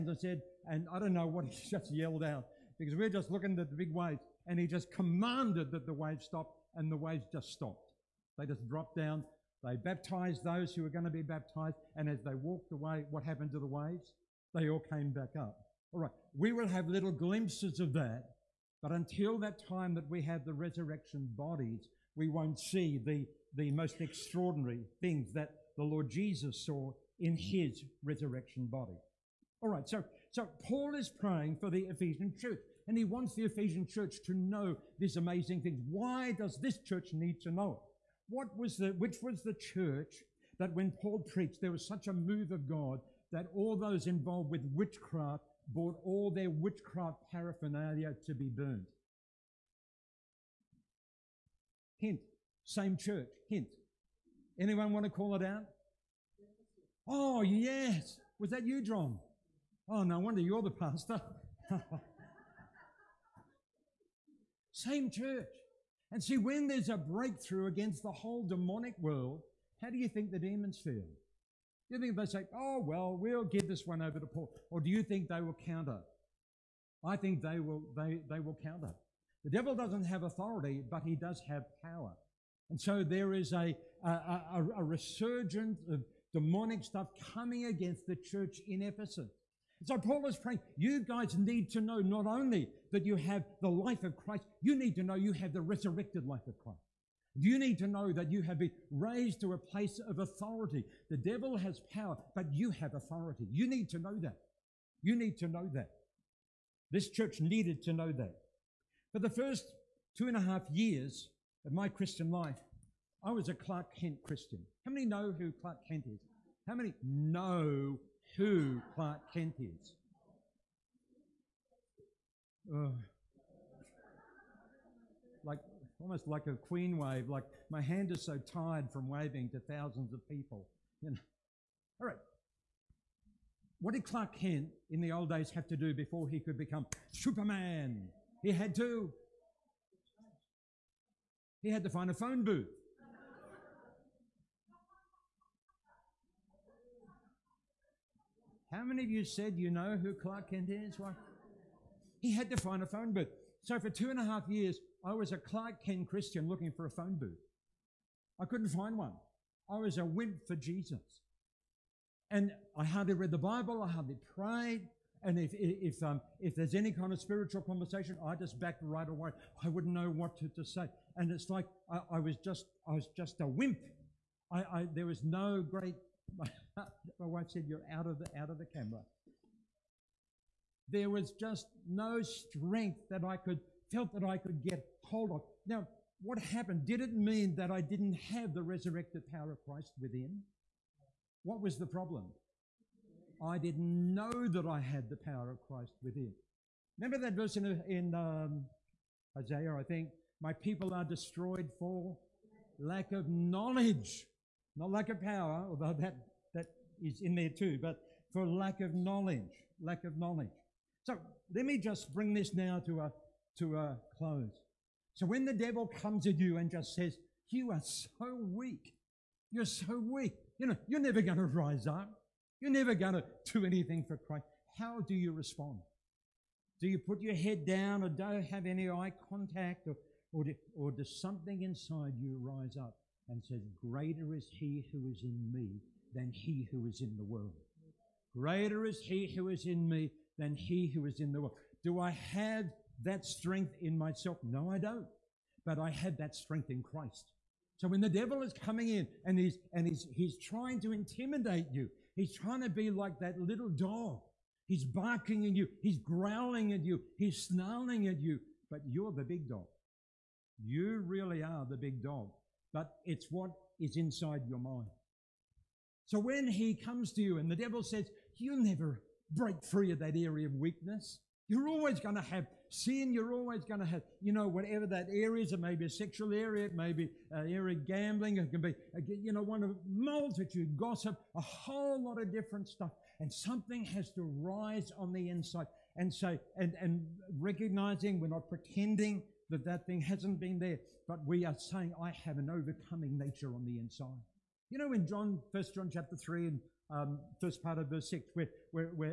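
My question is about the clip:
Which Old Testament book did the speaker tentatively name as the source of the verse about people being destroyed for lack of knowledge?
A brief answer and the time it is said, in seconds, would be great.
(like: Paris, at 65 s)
Isaiah, at 199 s.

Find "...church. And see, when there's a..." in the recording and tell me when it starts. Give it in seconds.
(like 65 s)
65 s.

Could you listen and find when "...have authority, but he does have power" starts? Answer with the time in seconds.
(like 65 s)
80 s.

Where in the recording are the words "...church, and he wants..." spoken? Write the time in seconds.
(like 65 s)
32 s.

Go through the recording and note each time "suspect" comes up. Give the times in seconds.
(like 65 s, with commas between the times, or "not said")
not said.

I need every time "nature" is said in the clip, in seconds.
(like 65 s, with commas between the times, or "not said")
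293 s.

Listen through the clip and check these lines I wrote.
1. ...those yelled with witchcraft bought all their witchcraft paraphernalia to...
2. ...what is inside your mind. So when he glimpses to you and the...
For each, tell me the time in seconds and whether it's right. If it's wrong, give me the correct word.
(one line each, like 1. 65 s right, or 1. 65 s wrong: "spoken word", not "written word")
1. 43 s wrong: "involved", not "yelled"
2. 263 s wrong: "comes", not "glimpses".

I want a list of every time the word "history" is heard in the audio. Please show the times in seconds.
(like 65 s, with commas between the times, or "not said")
not said.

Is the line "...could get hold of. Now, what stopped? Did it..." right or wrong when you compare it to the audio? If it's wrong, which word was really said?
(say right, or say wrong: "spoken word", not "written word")
wrong: "happened", not "stopped".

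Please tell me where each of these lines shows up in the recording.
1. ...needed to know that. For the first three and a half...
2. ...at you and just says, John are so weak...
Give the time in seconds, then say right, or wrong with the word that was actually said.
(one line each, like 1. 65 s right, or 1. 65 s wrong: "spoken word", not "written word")
1. 107 s wrong: "two", not "three"
2. 216 s wrong: "You", not "John".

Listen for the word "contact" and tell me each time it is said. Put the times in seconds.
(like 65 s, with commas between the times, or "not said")
229 s.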